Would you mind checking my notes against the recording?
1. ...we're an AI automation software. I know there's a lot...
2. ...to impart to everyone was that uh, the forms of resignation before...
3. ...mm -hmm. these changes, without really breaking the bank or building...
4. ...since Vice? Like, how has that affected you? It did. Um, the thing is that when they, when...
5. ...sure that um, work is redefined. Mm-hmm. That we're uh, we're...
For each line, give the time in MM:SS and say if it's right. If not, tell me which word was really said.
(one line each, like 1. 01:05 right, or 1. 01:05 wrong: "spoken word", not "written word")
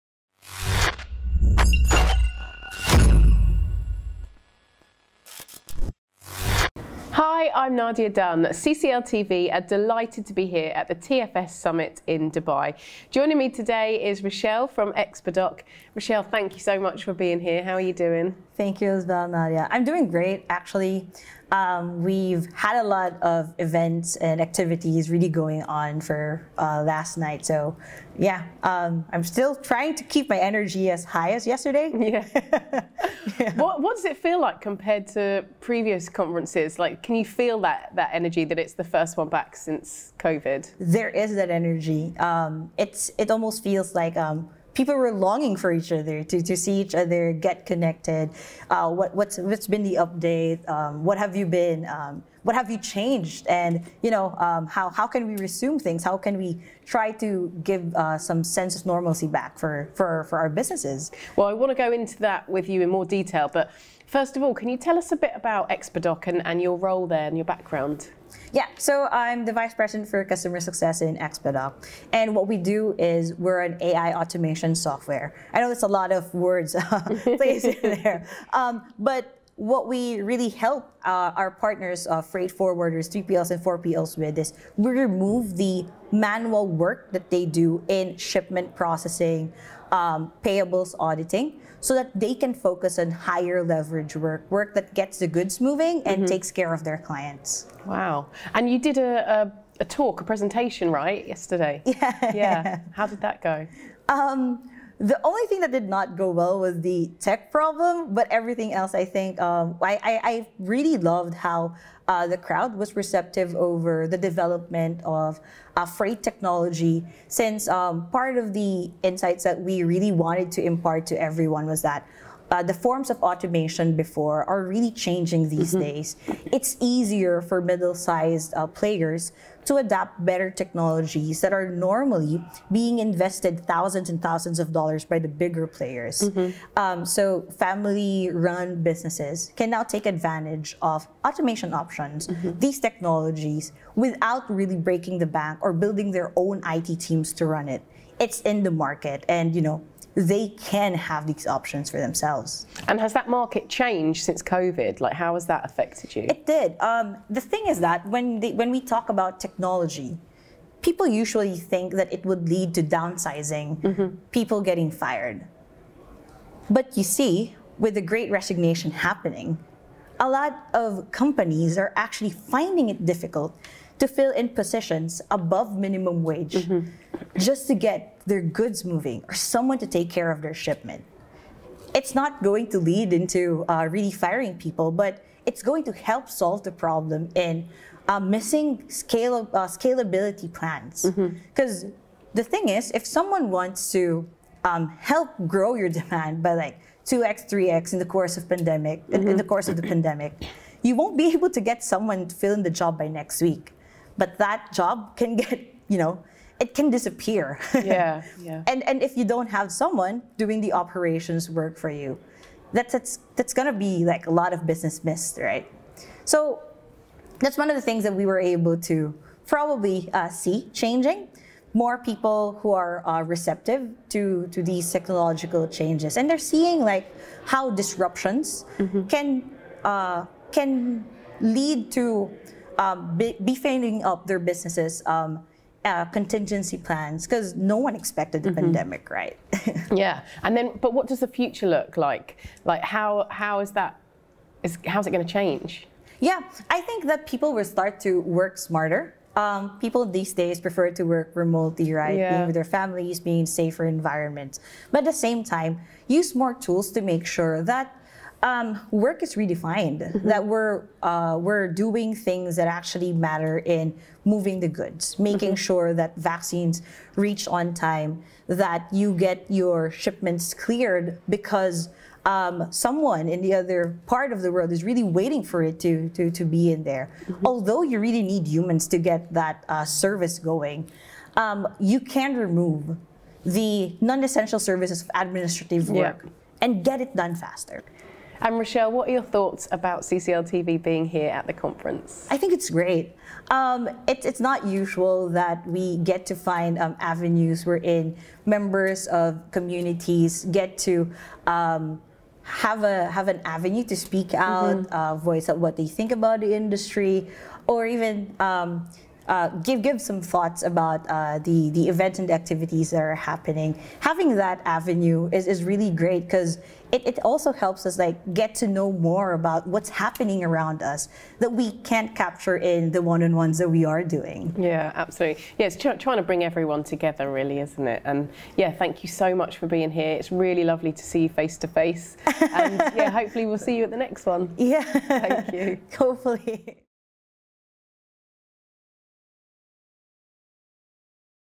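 1. 01:13 right
2. 02:00 wrong: "automation", not "resignation"
3. 02:22 wrong: "technologies", not "changes"
4. 02:34 wrong: "COVID", not "Vice"
5. 04:17 right.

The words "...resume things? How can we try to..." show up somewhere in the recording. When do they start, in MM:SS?
00:55.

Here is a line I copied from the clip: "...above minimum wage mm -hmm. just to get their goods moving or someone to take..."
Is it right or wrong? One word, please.
right.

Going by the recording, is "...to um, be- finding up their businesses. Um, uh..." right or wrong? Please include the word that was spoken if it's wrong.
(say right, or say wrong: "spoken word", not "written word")
wrong: "beefing", not "finding".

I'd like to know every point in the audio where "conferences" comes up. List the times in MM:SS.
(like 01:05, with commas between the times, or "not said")
00:36, 04:51.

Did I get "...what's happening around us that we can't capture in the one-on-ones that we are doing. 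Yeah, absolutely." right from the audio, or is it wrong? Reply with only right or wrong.
right.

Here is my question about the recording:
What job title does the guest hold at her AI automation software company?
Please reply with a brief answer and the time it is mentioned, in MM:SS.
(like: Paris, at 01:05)
Vice President for Customer Success, at 01:09.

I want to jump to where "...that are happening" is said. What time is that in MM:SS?
05:12.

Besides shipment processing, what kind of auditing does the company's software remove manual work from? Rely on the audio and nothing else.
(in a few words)
payables auditing.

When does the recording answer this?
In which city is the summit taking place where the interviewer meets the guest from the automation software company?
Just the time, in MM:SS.
00:12.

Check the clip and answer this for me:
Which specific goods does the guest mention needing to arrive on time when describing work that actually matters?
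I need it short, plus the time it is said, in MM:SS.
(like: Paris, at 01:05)
vaccines, at 04:26.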